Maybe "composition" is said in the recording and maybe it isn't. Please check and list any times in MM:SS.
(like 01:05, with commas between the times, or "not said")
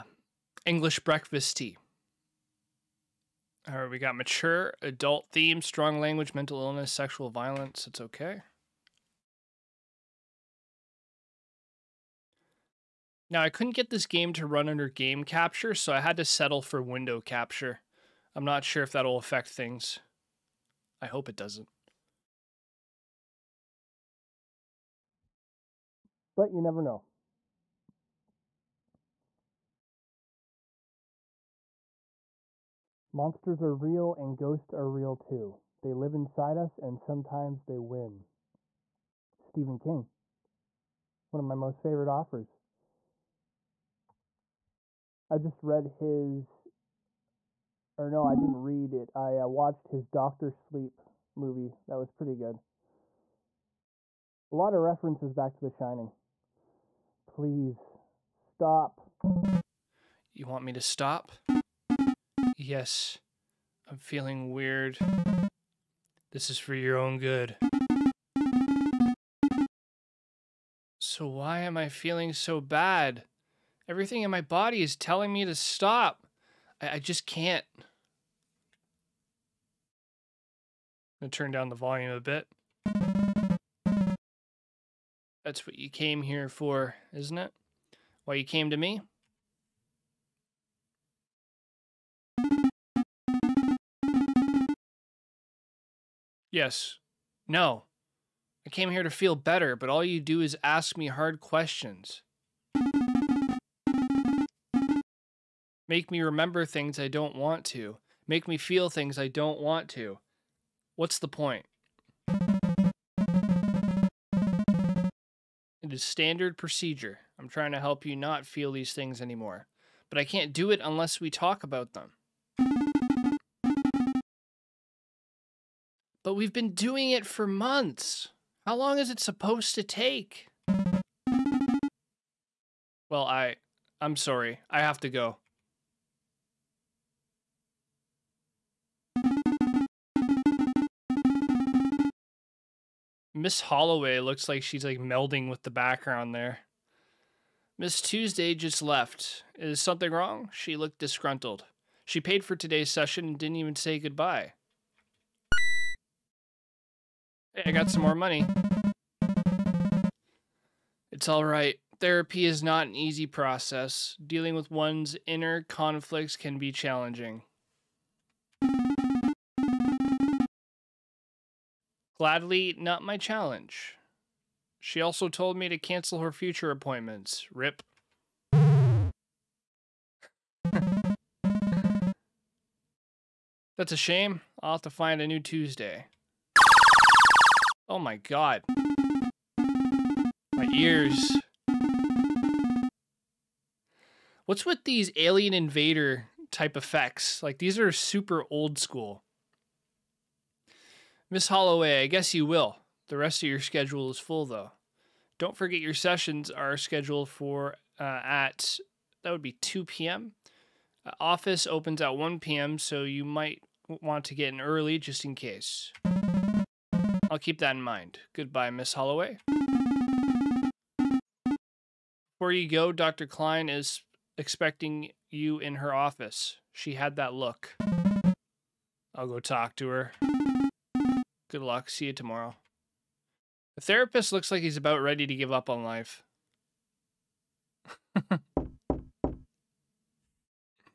not said.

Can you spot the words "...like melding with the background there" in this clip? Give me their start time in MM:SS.
02:24.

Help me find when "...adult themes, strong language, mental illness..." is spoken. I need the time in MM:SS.
00:04.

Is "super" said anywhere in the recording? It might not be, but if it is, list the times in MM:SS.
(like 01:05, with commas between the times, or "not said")
03:17.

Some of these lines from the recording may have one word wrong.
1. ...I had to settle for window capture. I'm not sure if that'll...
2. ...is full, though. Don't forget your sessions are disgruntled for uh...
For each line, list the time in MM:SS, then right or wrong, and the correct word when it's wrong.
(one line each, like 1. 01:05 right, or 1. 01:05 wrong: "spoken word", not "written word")
1. 00:15 right
2. 03:24 wrong: "scheduled", not "disgruntled".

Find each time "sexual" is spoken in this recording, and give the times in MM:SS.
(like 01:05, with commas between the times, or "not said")
00:06.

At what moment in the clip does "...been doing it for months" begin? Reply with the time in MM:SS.
02:06.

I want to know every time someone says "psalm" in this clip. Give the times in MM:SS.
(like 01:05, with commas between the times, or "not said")
not said.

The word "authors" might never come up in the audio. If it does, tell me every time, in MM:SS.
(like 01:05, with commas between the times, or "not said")
00:42.